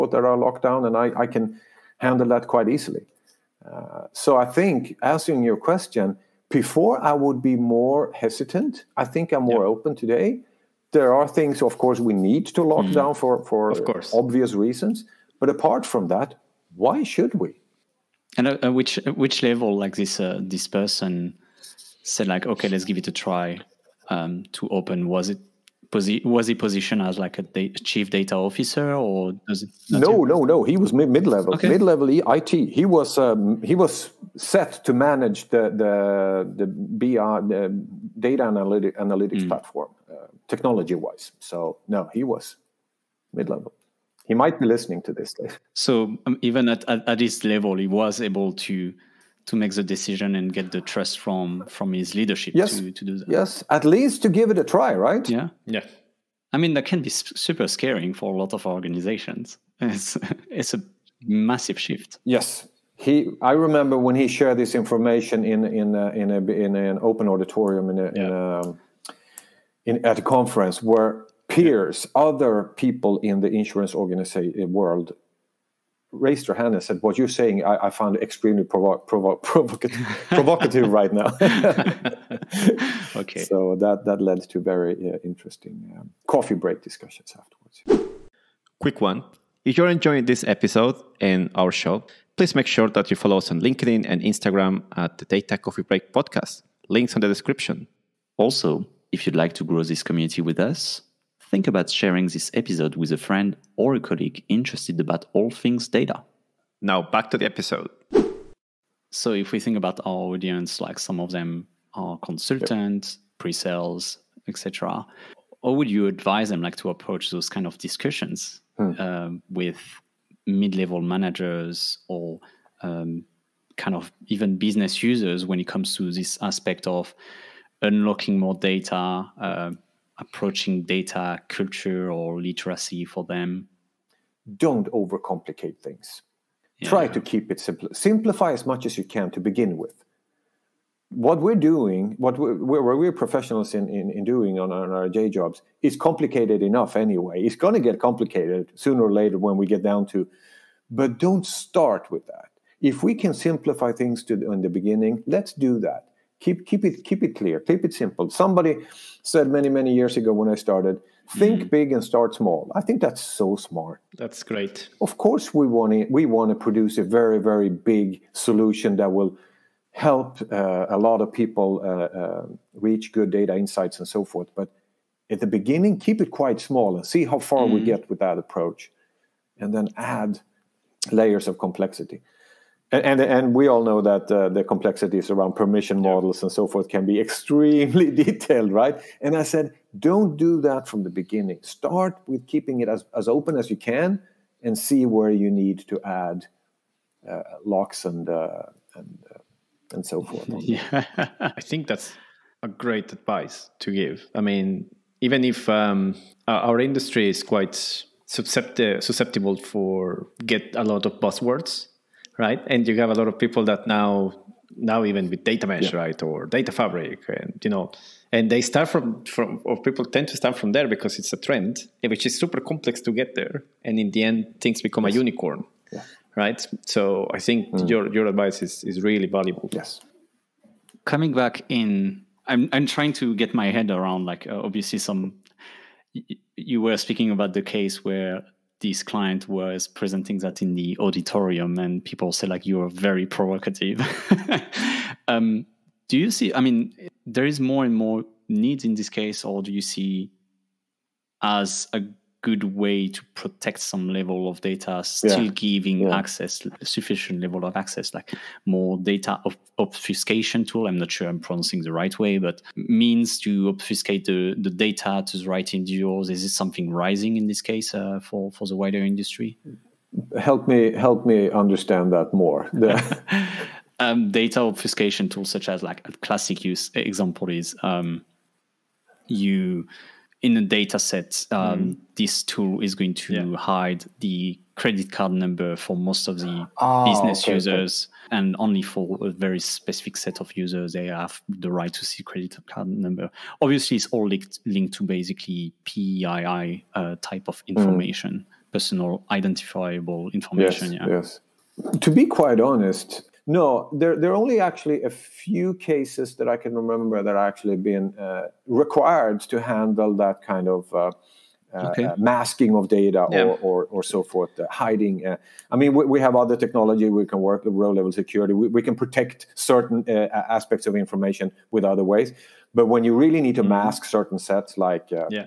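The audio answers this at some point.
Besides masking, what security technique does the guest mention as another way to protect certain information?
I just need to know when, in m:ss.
5:17.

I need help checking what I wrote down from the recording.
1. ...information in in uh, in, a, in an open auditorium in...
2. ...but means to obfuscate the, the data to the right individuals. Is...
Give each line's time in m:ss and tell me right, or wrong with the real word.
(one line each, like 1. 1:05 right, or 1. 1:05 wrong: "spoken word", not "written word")
1. 1:04 right
2. 4:22 right.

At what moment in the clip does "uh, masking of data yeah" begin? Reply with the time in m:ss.
5:12.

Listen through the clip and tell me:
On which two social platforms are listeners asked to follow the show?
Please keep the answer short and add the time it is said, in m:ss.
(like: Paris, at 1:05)
LinkedIn and Instagram, at 1:33.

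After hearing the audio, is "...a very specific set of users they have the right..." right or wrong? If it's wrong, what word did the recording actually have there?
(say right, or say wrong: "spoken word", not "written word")
right.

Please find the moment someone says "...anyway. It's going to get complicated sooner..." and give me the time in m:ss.
2:26.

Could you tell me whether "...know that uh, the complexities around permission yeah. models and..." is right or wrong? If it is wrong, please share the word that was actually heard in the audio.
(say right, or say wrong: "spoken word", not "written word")
right.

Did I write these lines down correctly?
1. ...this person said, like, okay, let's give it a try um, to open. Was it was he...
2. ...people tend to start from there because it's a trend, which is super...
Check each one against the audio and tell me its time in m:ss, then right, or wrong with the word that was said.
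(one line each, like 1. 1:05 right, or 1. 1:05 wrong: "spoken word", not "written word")
1. 0:20 right
2. 3:39 right.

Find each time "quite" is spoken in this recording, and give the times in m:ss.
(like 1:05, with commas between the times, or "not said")
0:02, 2:56, 3:27, 5:02.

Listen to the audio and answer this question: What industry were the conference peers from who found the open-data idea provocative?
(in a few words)
Insurance.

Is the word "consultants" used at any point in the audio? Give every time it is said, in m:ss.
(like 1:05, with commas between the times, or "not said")
1:52.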